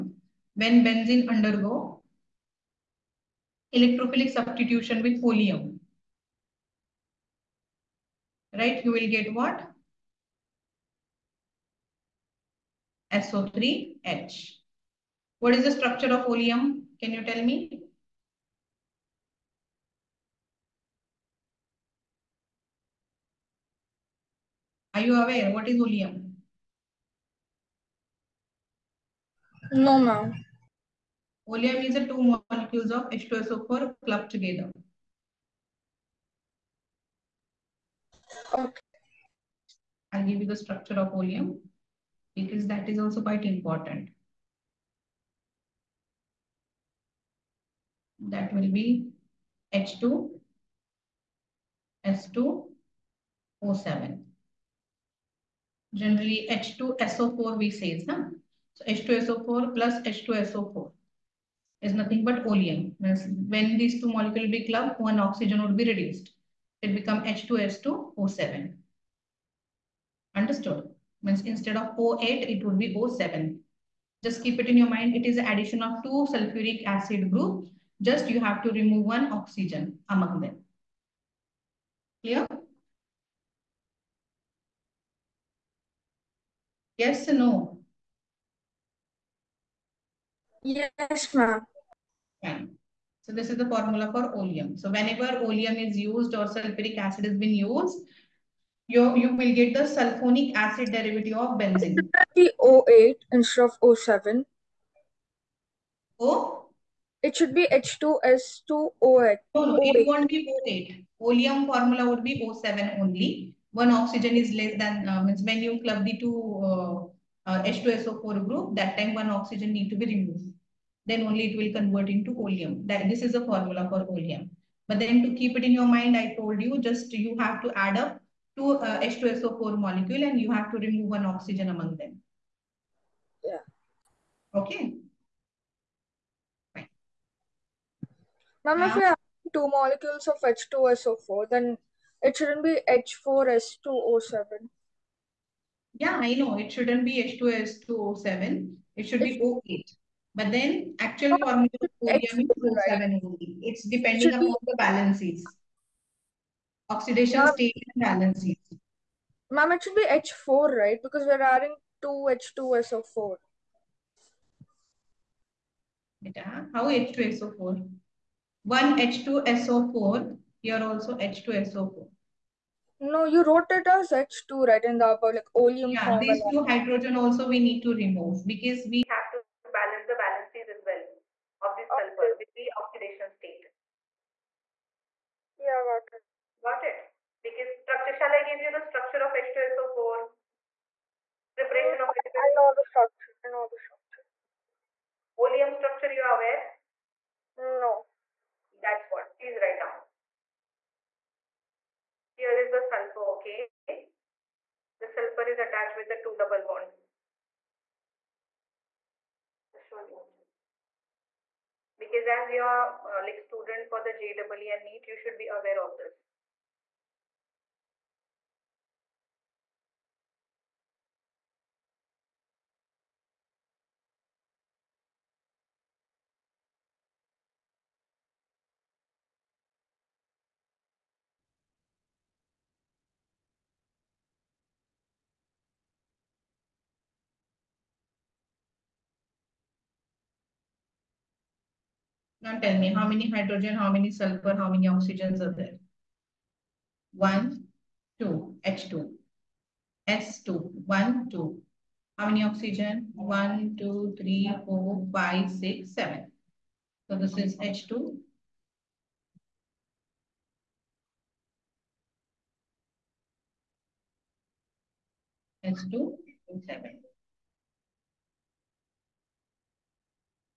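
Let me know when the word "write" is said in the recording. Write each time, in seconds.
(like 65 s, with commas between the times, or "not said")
199 s.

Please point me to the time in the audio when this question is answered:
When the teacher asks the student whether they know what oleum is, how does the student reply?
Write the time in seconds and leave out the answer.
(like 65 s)
29 s.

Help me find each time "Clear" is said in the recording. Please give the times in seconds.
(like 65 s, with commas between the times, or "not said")
82 s.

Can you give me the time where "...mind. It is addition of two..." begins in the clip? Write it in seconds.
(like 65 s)
74 s.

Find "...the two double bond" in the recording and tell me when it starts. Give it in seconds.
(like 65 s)
206 s.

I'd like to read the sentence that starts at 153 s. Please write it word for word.
It's depending it upon the balances.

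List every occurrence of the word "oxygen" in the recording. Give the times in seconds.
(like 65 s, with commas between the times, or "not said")
65 s, 79 s, 113 s, 119 s, 131 s, 244 s, 252 s.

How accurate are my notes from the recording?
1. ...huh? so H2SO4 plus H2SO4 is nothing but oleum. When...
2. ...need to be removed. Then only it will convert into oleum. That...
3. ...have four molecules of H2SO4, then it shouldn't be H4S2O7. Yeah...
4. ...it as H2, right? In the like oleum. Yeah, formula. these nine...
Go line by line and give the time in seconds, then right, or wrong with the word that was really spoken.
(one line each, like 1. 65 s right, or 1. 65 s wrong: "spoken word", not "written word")
1. 58 s right
2. 119 s right
3. 139 s wrong: "two", not "four"
4. 173 s wrong: "two", not "nine".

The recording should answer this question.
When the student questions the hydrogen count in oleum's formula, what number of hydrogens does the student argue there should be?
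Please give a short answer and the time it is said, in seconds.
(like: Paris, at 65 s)
4, at 159 s.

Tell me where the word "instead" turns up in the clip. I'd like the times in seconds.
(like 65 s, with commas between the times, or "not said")
71 s, 103 s.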